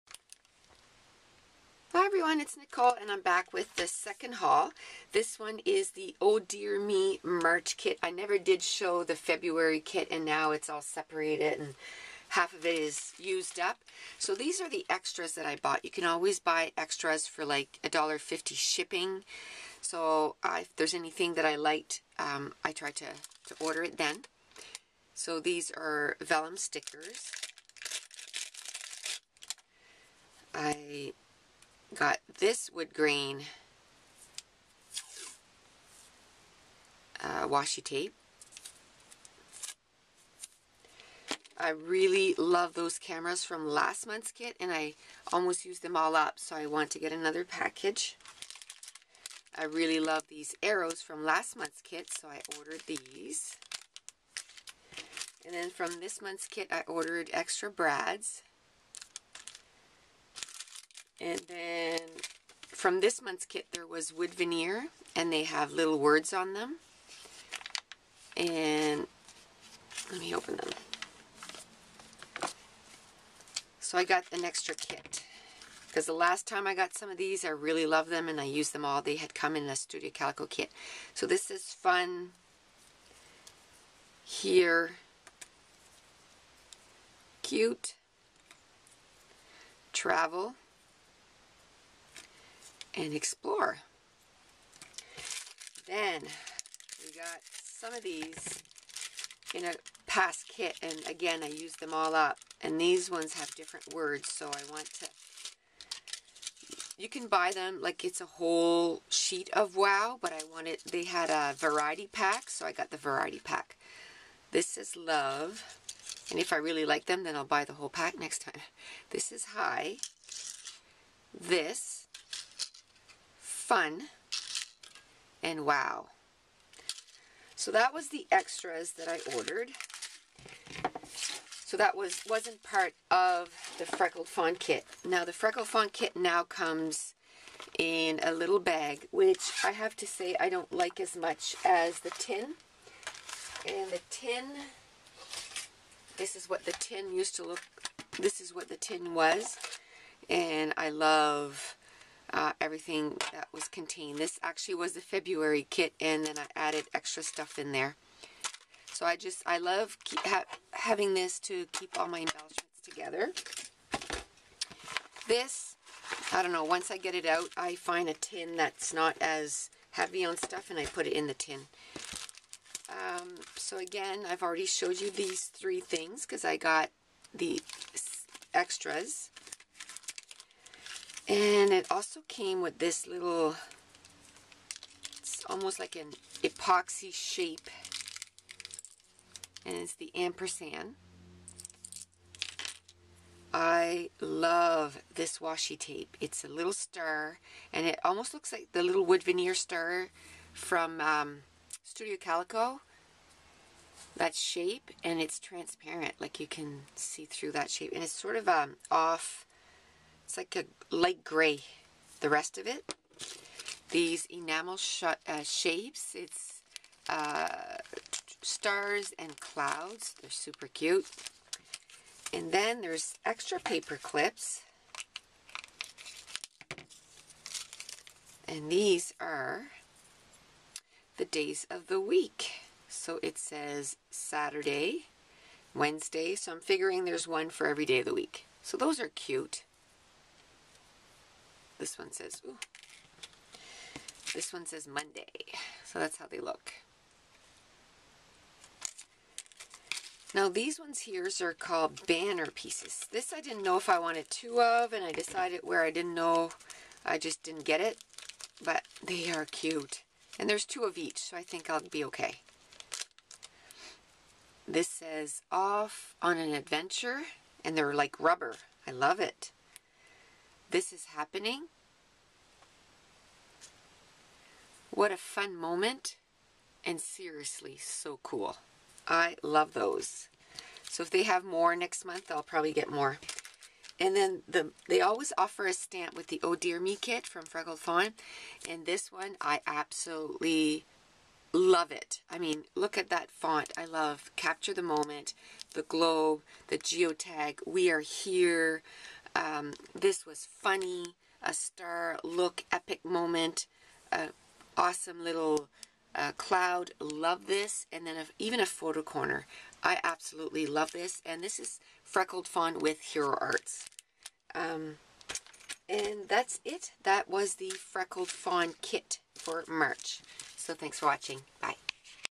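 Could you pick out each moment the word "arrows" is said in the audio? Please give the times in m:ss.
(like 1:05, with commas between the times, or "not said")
0:50.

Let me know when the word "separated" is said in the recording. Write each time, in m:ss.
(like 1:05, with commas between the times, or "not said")
0:10.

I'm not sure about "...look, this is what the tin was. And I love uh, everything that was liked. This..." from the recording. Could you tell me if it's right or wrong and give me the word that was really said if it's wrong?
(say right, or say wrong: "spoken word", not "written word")
wrong: "contained", not "liked".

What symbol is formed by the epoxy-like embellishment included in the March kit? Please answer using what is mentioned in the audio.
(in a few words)
ampersand.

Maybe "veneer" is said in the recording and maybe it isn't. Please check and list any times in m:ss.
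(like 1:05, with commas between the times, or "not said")
1:04, 3:19.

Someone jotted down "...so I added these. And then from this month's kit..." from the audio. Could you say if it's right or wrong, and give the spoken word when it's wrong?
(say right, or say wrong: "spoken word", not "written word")
wrong: "ordered", not "added".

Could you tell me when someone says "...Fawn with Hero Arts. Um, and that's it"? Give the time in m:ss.
5:12.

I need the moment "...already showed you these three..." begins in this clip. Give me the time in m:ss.
2:54.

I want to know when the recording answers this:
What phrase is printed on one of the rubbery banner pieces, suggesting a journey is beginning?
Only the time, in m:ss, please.
4:25.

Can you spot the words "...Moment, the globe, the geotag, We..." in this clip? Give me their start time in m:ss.
4:54.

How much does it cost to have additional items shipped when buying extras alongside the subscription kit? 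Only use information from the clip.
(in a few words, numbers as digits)
$1.50.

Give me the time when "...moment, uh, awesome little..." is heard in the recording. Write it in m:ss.
5:03.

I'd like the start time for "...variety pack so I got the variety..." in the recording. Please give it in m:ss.
1:51.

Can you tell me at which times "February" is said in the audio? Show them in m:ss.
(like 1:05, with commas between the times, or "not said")
0:09, 2:35.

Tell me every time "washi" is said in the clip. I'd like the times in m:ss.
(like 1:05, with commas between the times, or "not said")
0:37, 3:15.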